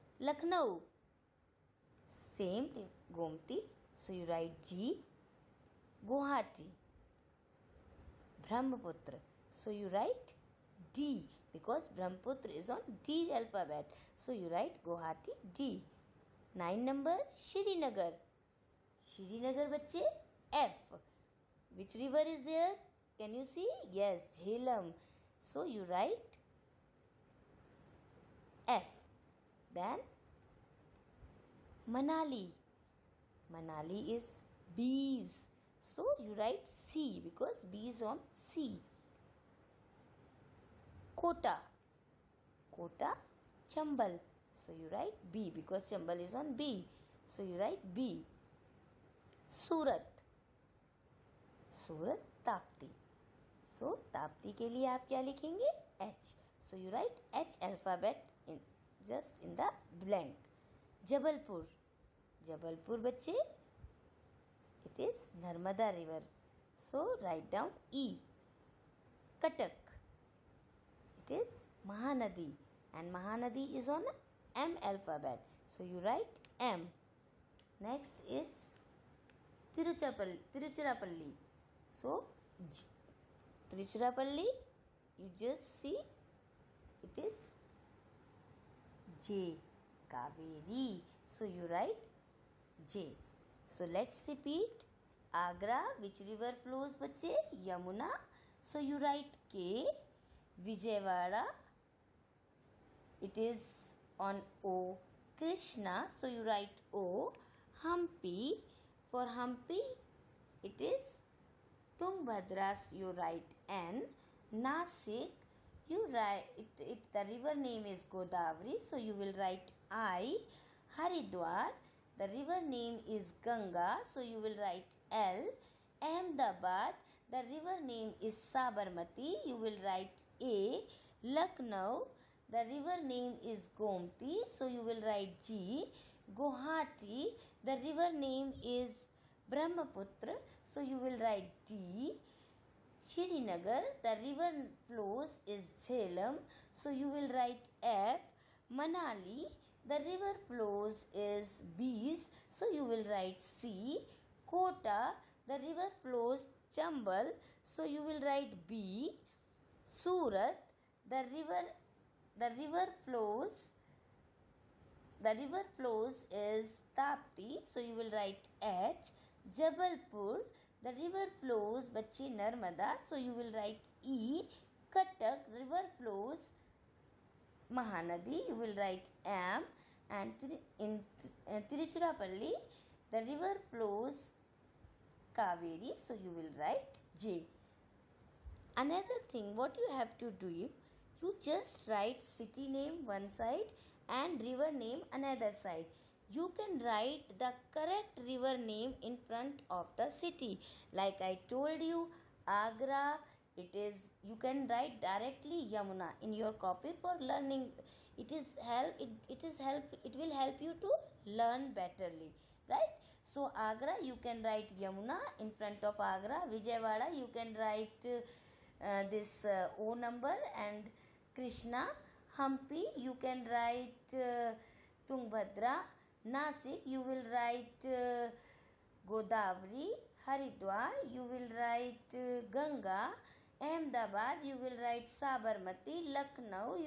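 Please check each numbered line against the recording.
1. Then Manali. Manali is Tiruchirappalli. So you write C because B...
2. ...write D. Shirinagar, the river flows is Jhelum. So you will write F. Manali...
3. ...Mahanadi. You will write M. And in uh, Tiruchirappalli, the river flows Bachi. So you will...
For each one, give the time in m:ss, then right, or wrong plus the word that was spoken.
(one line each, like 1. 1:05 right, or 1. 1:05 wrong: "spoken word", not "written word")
1. 0:29 wrong: "Beas", not "Tiruchirappalli"
2. 2:21 right
3. 2:57 wrong: "Kaveri", not "Bachi".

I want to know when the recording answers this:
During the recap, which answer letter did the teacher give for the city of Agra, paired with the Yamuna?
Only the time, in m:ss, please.
1:39.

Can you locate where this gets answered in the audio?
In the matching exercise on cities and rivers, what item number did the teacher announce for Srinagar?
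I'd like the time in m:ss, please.
0:16.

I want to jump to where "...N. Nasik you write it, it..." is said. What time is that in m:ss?
1:53.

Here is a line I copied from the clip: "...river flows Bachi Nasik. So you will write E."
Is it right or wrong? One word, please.
wrong.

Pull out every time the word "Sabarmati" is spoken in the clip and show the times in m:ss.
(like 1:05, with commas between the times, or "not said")
2:08, 3:55.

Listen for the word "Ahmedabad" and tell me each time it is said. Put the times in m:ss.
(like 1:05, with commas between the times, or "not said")
2:06, 3:53.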